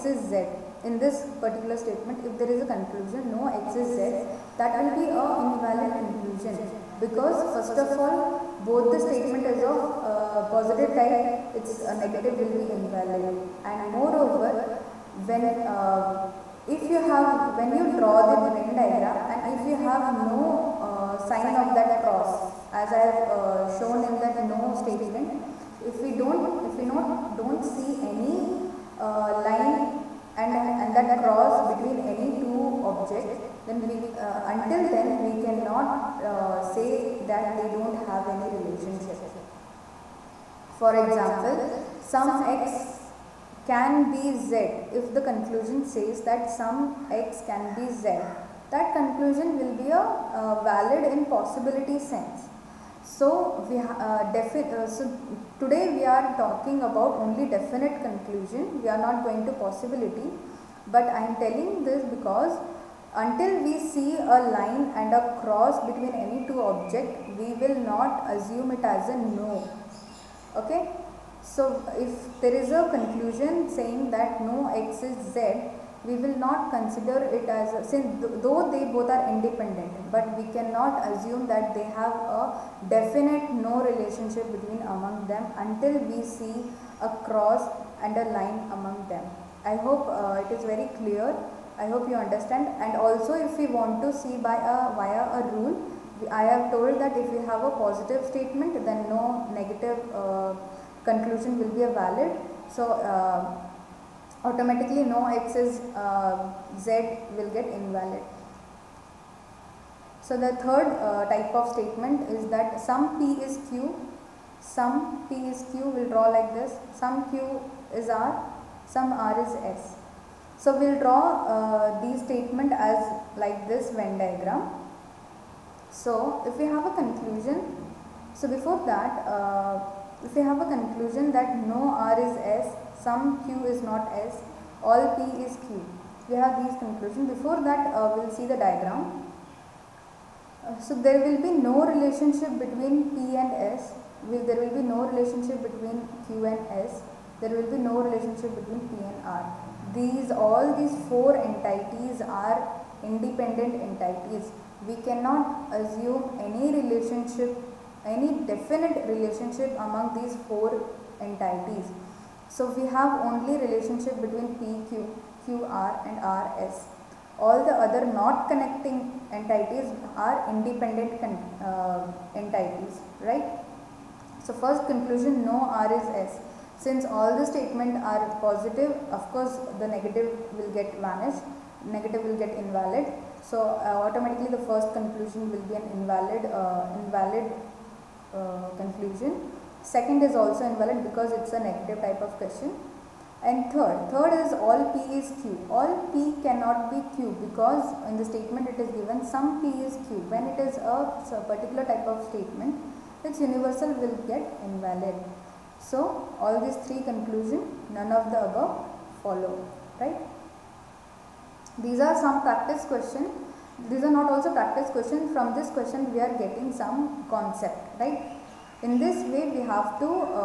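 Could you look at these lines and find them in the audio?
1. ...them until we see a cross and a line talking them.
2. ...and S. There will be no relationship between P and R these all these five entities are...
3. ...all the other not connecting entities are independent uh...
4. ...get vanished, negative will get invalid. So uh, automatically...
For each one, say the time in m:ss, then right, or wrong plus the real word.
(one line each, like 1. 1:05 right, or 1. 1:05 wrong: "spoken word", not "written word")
1. 1:25 wrong: "among", not "talking"
2. 2:26 wrong: "four", not "five"
3. 2:47 right
4. 3:00 right.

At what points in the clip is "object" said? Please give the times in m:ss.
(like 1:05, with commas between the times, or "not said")
0:32, 1:06.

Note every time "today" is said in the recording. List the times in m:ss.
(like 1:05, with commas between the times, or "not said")
0:55.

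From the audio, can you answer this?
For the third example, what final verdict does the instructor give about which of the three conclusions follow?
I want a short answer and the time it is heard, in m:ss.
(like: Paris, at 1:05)
None of the above, at 3:27.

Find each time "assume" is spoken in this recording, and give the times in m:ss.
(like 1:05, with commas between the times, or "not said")
1:08, 1:21, 2:35.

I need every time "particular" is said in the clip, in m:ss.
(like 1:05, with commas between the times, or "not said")
0:01, 3:21.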